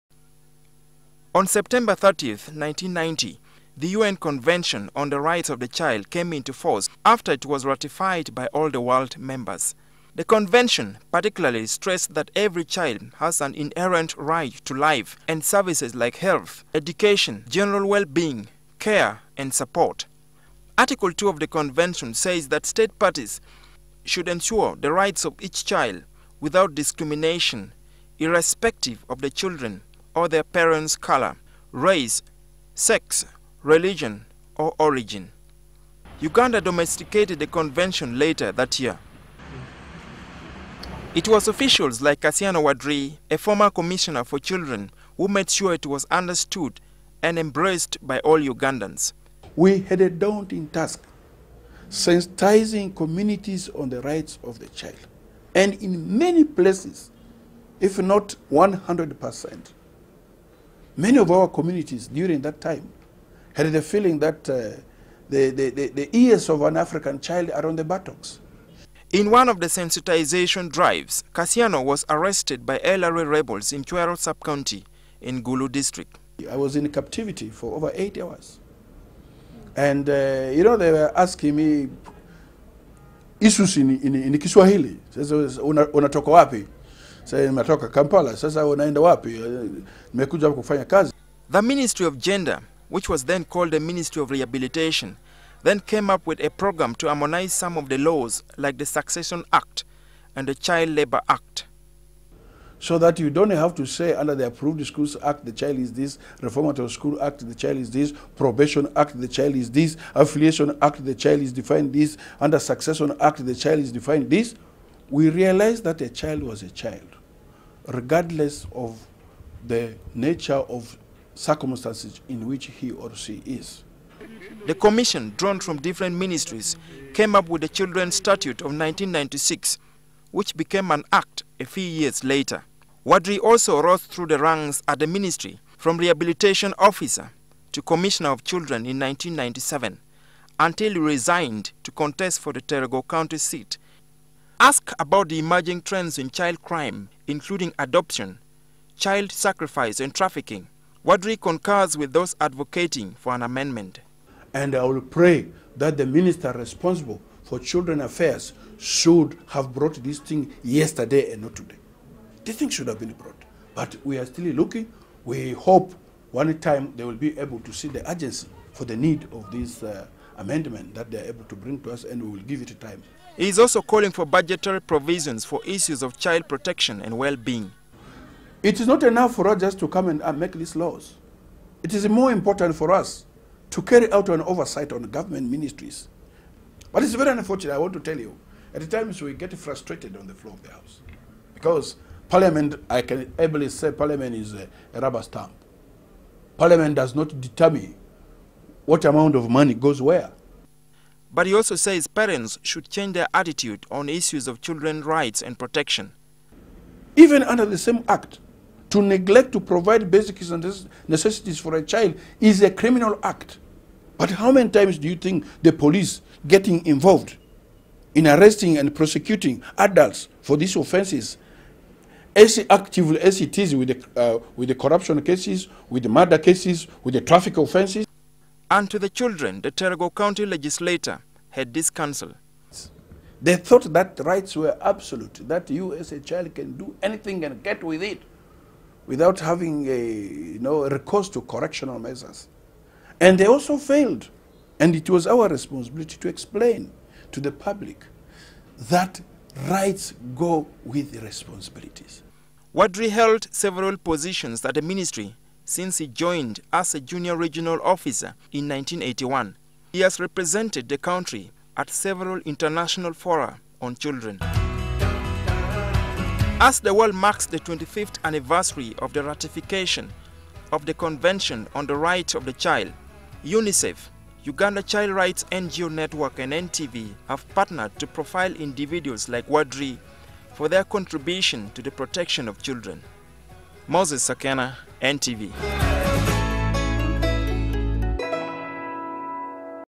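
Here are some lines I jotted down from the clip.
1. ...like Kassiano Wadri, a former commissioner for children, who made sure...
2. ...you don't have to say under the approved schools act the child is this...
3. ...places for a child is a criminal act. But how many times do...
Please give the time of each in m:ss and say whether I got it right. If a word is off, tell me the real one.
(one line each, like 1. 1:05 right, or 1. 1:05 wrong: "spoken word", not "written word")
1. 0:42 right
2. 1:43 right
3. 3:31 wrong: "necessities", not "places".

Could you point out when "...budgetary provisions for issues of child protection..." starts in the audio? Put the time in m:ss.
2:54.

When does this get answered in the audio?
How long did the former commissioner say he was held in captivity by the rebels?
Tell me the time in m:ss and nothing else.
1:17.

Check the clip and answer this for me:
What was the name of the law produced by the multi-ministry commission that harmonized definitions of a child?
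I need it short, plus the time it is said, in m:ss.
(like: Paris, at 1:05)
Children's Statute of 1996, at 2:07.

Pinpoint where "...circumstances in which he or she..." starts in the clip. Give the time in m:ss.
2:01.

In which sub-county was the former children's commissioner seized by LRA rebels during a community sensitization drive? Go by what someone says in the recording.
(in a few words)
Chuero.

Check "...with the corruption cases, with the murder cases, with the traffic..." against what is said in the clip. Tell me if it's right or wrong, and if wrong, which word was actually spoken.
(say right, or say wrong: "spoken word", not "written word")
right.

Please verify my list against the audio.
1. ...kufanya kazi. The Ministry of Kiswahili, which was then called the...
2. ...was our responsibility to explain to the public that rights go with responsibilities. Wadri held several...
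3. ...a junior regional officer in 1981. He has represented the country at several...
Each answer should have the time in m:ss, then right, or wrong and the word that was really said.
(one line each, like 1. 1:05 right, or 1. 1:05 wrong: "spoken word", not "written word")
1. 1:30 wrong: "Gender", not "Kiswahili"
2. 4:05 right
3. 4:16 right.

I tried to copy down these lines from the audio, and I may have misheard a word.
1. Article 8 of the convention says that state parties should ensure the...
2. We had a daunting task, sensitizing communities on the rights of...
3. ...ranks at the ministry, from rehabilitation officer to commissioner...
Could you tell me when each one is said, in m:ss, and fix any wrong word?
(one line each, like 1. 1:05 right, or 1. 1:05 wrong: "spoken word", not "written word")
1. 0:20 wrong: "2", not "8"
2. 0:49 right
3. 2:14 right.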